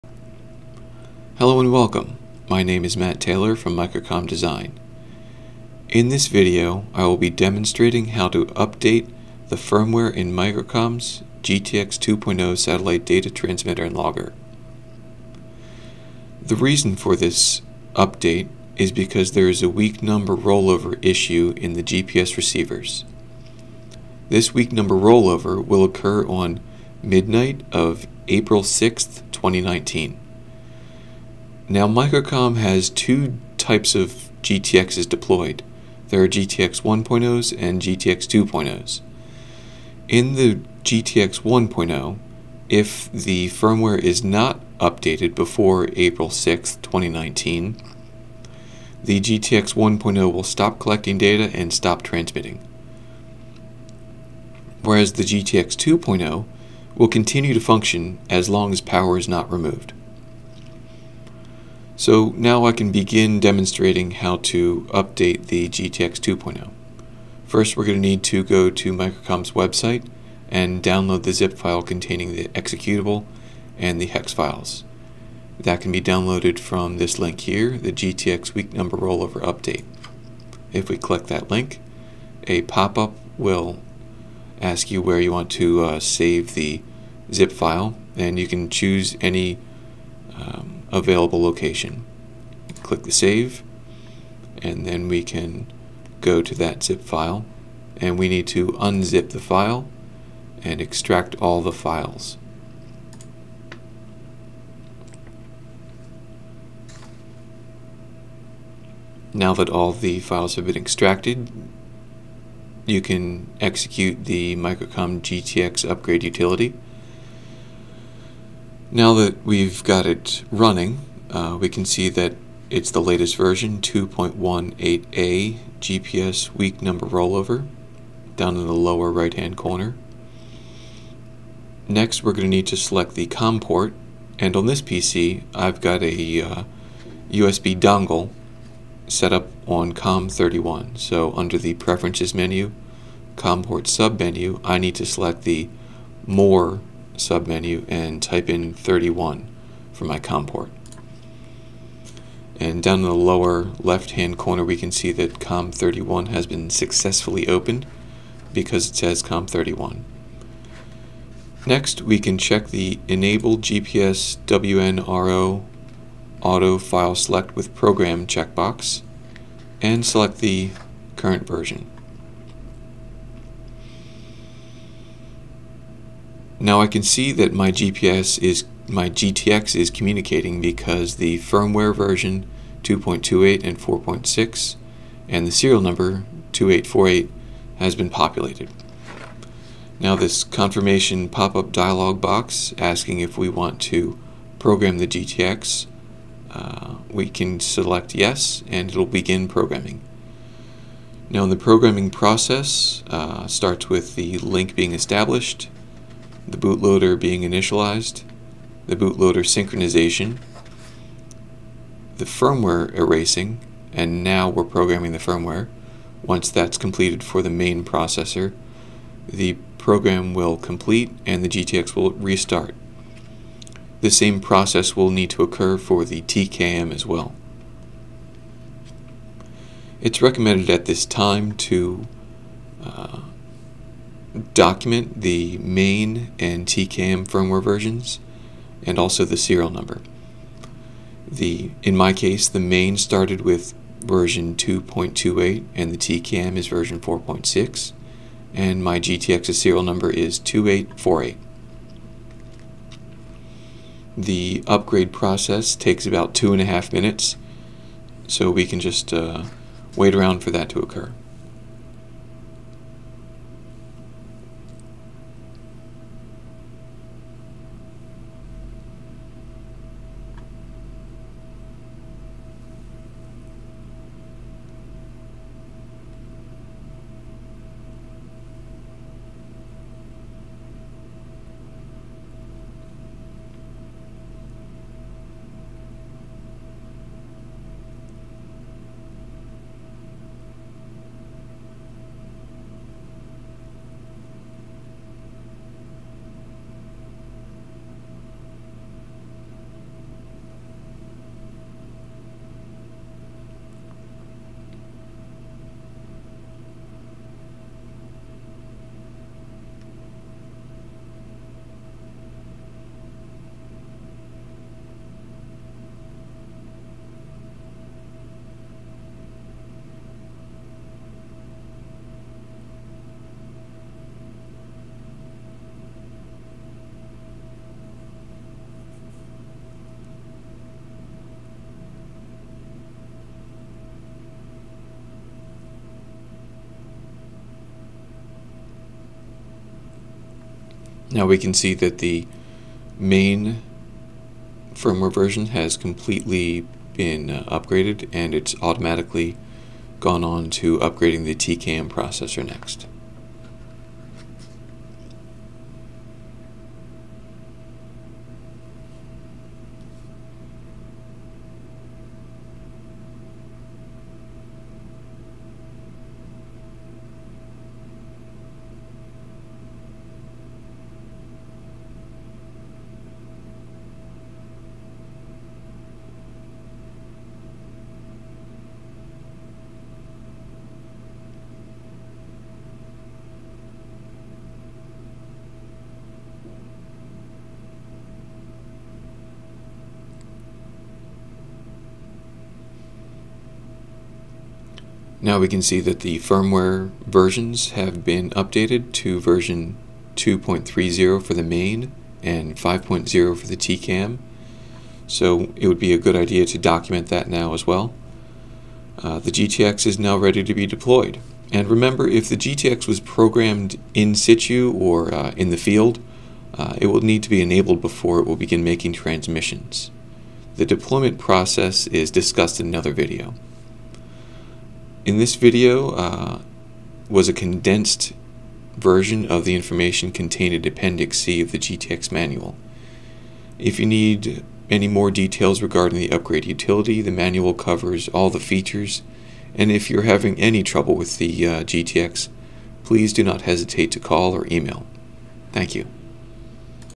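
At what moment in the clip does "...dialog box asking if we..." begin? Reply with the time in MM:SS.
03:11.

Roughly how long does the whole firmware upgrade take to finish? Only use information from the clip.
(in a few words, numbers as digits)
About two and a half minutes.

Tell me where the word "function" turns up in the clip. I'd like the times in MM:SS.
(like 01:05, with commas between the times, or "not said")
00:57.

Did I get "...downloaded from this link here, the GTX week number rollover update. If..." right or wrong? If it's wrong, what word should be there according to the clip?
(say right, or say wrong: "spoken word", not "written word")
right.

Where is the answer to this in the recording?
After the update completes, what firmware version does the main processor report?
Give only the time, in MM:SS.
06:40.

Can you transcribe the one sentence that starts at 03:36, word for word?
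Once that's completed for the main processor, the program will complete and the GTX will restart.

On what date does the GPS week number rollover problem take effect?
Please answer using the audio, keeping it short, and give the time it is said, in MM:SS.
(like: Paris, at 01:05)
April 6th, 2019, at 00:28.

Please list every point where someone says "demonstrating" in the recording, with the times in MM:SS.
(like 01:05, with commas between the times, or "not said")
00:07, 01:03.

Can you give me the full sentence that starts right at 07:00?
The deployment process is discussed in another video.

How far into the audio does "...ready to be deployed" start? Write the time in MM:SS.
06:50.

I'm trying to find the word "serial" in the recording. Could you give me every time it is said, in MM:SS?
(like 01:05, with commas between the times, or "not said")
03:05, 03:59, 04:09.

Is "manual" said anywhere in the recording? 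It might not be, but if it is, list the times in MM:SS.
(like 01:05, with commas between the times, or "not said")
07:12, 07:17.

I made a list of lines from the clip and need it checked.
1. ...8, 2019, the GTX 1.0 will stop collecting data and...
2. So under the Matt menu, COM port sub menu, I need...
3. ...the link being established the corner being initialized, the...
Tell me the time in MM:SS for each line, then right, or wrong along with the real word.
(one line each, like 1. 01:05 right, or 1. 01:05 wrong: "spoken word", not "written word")
1. 00:46 wrong: "6", not "8"
2. 02:20 wrong: "Preferences", not "Matt"
3. 03:24 wrong: "bootloader", not "corner".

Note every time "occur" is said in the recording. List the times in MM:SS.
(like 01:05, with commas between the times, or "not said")
00:25, 03:45, 04:20.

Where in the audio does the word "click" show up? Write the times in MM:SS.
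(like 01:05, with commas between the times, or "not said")
01:20, 01:32.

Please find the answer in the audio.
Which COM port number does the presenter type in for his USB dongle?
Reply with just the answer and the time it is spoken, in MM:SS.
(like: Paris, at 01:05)
31, at 02:28.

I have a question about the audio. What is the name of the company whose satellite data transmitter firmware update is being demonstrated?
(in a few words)
Microcom Design.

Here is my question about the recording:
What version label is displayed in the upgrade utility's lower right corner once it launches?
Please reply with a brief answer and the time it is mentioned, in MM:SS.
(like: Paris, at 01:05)
2.18a, at 02:03.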